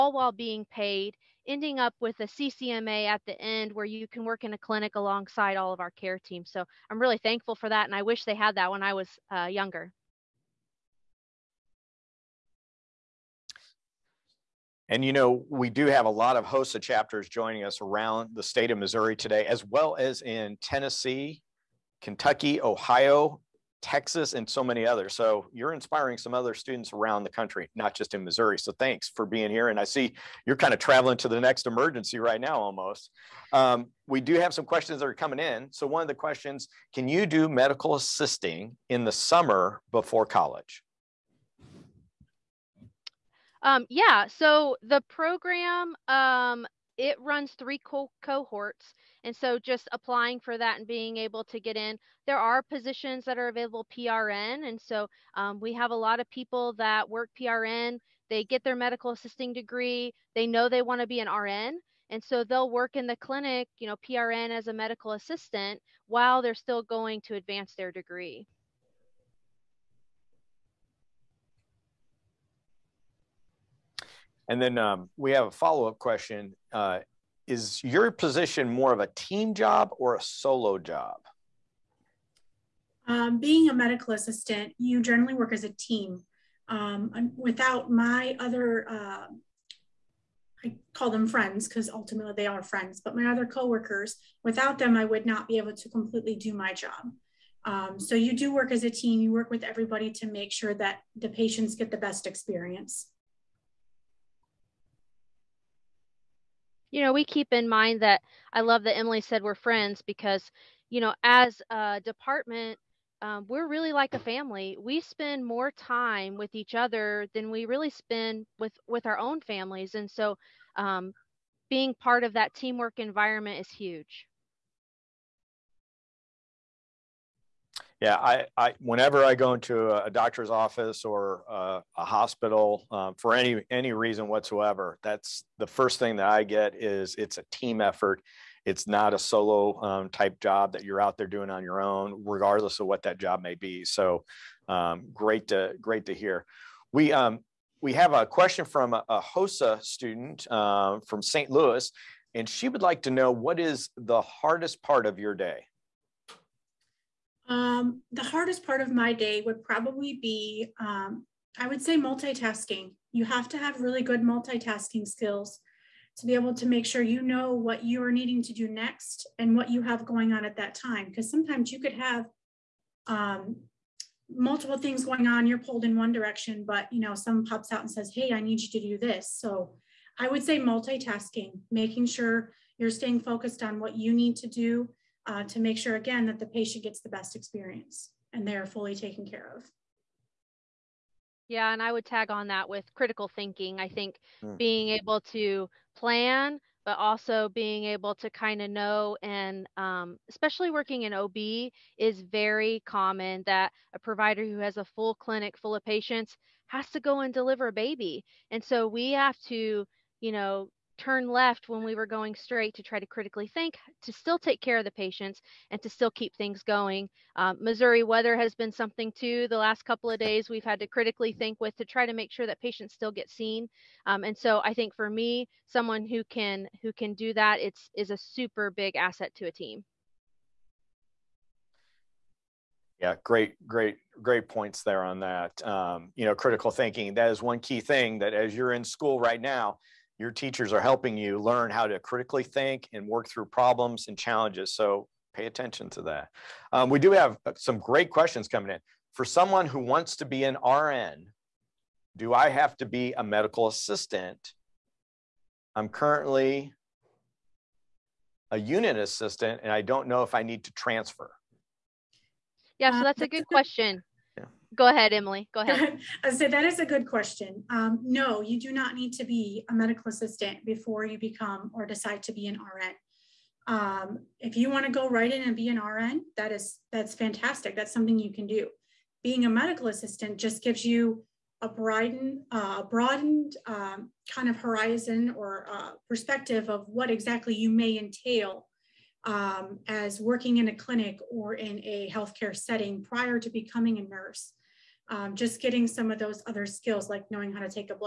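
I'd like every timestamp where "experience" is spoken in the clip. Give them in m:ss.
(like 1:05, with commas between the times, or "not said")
1:42, 3:07.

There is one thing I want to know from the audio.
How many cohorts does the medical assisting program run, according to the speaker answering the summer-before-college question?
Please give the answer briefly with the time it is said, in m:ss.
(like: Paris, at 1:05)
3, at 0:47.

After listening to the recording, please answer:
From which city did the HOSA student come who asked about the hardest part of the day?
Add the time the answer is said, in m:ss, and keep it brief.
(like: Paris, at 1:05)
St. Louis, at 2:31.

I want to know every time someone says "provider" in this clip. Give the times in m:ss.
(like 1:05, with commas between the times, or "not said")
3:23.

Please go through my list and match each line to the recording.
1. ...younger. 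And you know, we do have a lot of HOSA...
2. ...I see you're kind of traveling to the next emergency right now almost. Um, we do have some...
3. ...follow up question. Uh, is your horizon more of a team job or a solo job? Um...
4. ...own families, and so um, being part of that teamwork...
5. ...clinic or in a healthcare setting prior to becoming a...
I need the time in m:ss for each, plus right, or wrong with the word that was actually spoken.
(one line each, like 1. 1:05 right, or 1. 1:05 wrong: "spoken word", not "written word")
1. 0:09 right
2. 0:29 right
3. 1:15 wrong: "position", not "horizon"
4. 1:59 right
5. 4:50 right.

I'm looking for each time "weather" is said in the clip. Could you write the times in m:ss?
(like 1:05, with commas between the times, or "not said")
3:38.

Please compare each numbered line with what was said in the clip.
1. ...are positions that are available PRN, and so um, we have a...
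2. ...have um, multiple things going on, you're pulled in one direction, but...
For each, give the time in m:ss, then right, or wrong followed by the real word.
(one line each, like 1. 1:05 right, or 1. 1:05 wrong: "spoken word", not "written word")
1. 0:52 right
2. 2:51 right.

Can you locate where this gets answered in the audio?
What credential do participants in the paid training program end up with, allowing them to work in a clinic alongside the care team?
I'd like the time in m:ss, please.
0:02.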